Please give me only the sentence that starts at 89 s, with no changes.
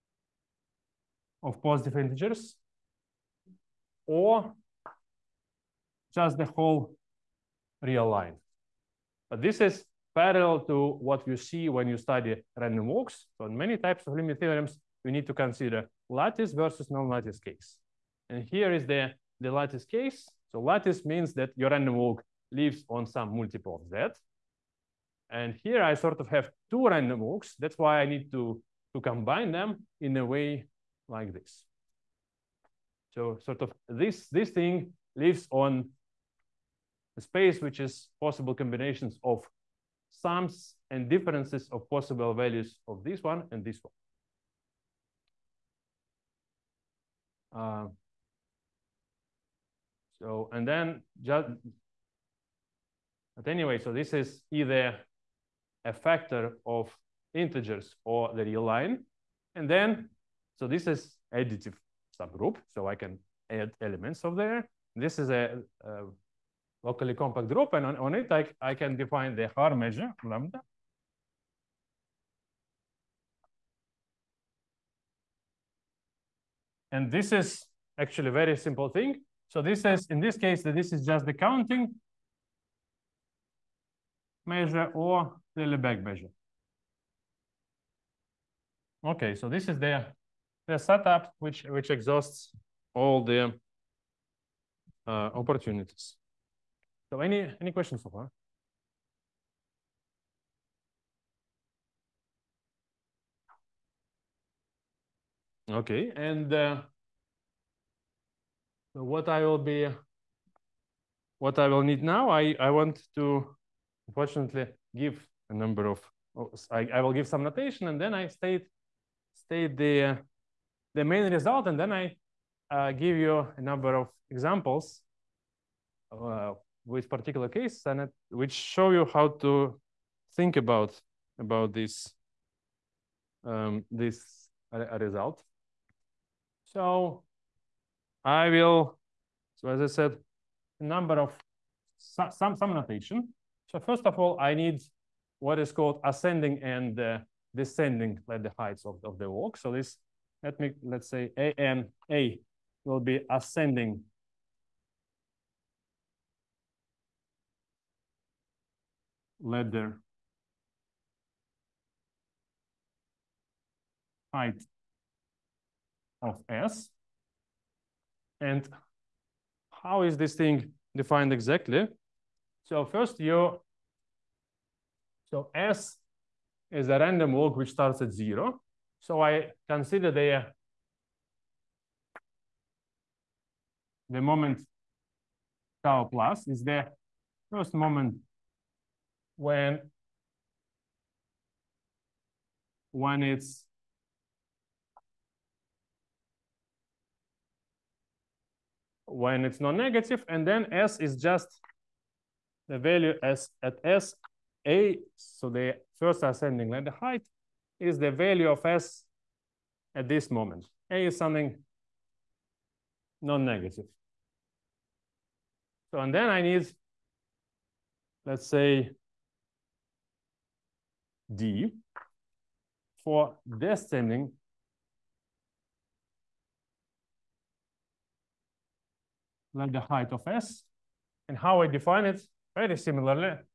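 Okay, so this is the the setup which which exhausts all the uh, opportunities.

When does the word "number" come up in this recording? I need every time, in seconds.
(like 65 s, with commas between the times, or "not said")
115 s, 123 s, 140 s.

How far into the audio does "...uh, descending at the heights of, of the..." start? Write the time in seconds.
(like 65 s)
146 s.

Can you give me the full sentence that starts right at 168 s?
And how is this thing defined exactly?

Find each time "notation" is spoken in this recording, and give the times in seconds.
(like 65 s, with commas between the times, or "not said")
117 s, 142 s.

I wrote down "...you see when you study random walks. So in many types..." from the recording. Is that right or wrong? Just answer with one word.
right.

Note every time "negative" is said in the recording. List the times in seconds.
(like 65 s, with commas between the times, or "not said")
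199 s, 213 s.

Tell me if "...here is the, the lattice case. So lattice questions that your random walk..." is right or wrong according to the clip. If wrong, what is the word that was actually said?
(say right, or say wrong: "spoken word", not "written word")
wrong: "means", not "questions".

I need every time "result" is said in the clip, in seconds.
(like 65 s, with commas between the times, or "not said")
121 s, 134 s.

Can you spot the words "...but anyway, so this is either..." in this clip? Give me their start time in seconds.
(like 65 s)
53 s.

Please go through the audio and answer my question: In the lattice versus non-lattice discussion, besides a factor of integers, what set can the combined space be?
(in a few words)
the real line.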